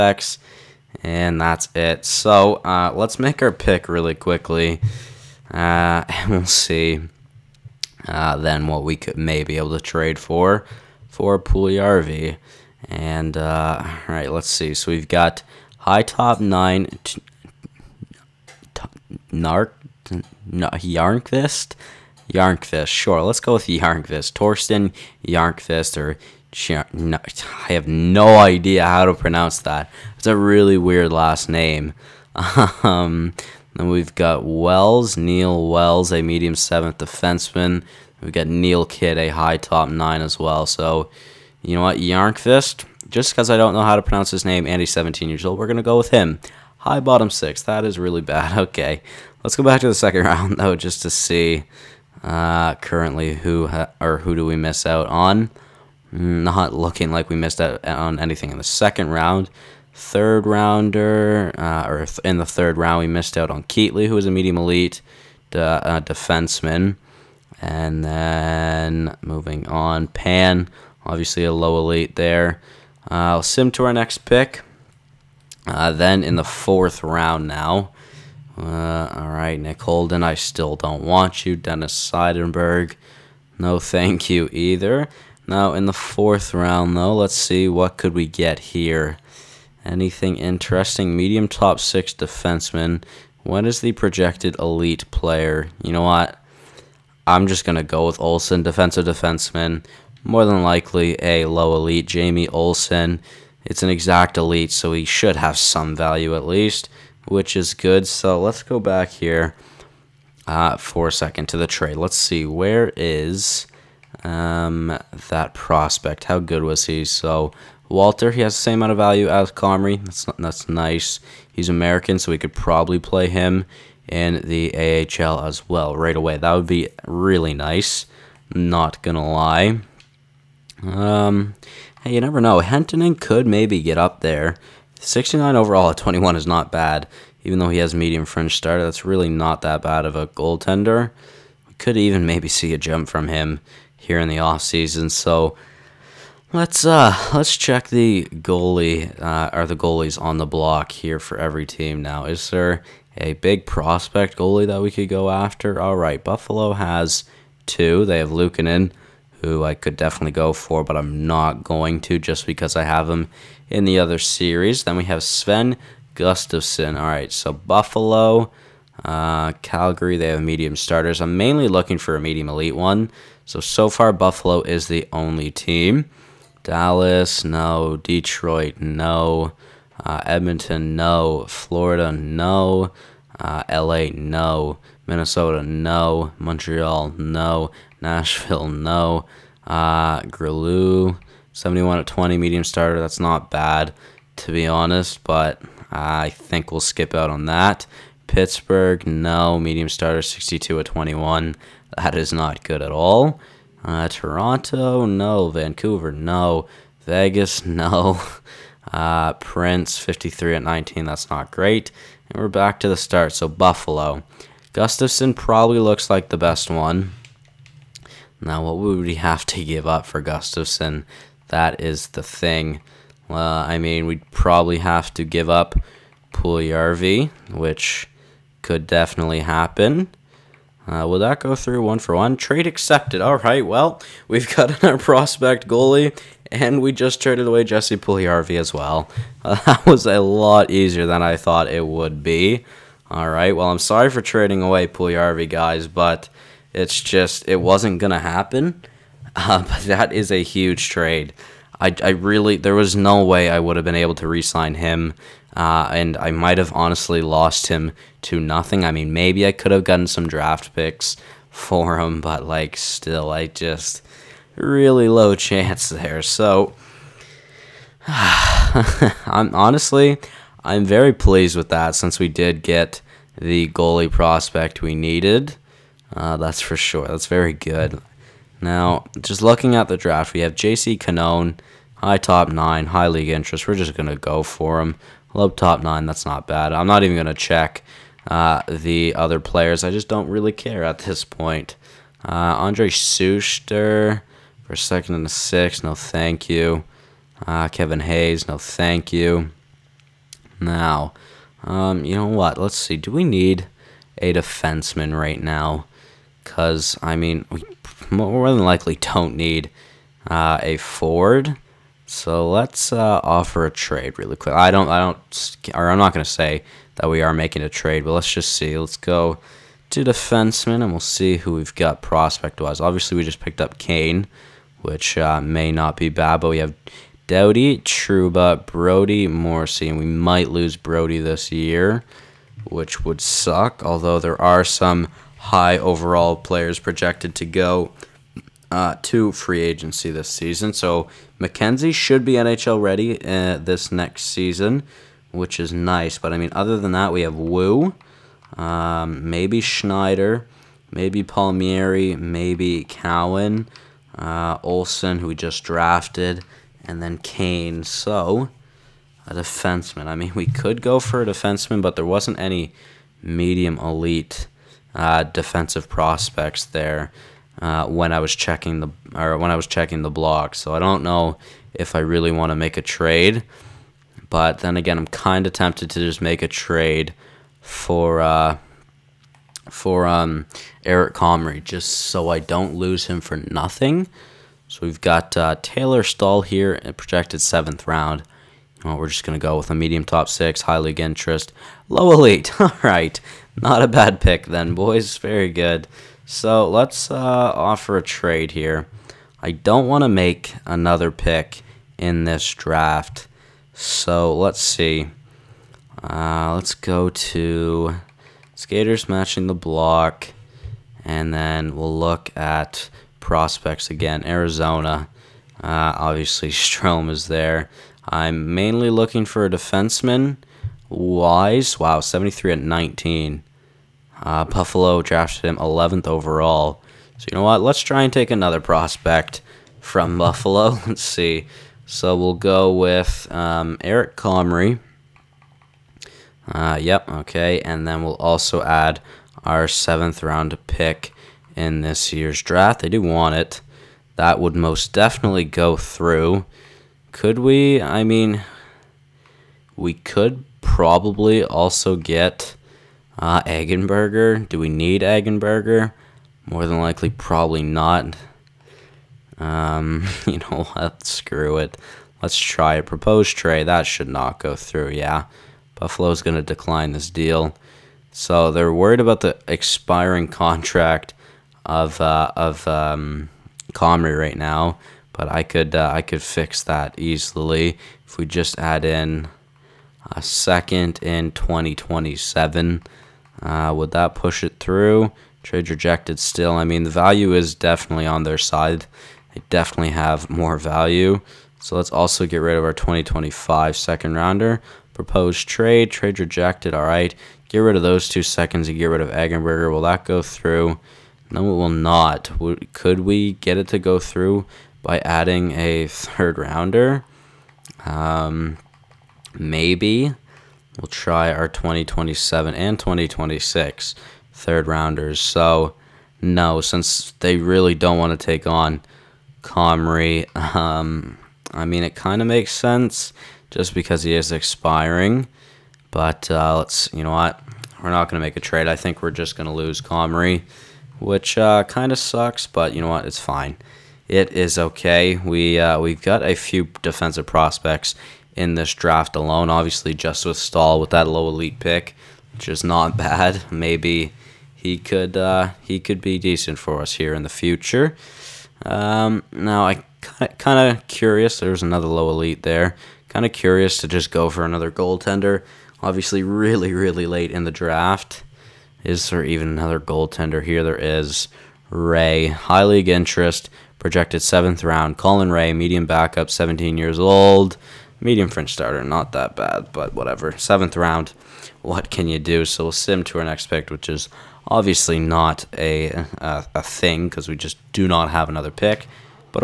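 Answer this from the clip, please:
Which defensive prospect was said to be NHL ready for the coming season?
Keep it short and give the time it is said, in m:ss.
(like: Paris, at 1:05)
McKenzie, at 5:41.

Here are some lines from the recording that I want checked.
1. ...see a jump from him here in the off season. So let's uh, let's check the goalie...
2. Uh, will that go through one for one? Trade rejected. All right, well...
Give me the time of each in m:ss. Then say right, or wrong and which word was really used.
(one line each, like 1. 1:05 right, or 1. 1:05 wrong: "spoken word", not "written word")
1. 2:22 right
2. 3:50 wrong: "accepted", not "rejected".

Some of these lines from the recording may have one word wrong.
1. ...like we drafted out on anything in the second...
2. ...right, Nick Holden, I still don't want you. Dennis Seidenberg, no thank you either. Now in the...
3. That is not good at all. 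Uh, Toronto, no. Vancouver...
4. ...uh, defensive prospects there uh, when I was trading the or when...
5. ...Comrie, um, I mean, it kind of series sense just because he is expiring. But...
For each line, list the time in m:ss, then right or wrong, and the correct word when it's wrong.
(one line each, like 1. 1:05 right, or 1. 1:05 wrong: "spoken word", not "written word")
1. 0:57 wrong: "missed", not "drafted"
2. 1:19 right
3. 3:21 right
4. 6:04 wrong: "checking", not "trading"
5. 8:39 wrong: "makes", not "series".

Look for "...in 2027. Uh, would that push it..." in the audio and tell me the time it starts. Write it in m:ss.
8:01.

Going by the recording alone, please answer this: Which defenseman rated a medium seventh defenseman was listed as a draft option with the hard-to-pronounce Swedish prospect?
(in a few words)
Neil Wells.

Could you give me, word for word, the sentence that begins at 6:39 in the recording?
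I don't want to make another pick in this draft.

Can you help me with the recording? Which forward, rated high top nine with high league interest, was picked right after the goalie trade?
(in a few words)
J.C. Canone.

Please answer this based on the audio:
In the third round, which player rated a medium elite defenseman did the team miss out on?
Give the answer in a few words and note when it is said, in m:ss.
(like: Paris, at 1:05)
Keatley, at 1:03.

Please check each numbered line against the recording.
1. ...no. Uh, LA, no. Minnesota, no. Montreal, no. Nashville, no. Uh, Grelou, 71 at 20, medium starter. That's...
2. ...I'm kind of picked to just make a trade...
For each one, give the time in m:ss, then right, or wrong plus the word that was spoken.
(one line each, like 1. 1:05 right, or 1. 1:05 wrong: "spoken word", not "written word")
1. 3:02 right
2. 6:14 wrong: "tempted", not "picked".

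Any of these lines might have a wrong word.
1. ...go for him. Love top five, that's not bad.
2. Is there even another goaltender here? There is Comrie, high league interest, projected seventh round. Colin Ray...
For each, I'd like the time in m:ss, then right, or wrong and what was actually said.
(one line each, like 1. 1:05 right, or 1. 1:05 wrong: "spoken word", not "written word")
1. 4:44 wrong: "nine", not "five"
2. 9:18 wrong: "Ray", not "Comrie".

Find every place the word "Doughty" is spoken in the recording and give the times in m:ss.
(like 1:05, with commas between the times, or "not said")
5:27.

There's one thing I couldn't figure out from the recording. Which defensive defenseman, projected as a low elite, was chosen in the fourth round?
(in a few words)
Jamie Olson.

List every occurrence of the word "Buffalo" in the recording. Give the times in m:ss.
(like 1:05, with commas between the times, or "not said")
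2:36, 2:47, 2:54, 3:33, 7:04, 7:10, 7:45.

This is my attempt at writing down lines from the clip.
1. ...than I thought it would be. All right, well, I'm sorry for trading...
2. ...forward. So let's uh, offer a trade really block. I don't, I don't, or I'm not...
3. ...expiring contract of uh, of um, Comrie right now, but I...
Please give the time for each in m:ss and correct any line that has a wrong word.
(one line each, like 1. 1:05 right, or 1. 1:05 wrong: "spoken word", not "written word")
1. 4:01 right
2. 5:10 wrong: "quick", not "block"
3. 7:49 right.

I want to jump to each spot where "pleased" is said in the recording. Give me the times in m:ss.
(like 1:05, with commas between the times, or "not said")
4:31.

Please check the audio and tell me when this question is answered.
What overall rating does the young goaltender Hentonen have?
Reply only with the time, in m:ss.
2:15.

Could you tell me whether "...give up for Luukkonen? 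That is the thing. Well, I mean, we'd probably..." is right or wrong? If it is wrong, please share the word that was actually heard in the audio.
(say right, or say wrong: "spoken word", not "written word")
wrong: "Gustafson", not "Luukkonen".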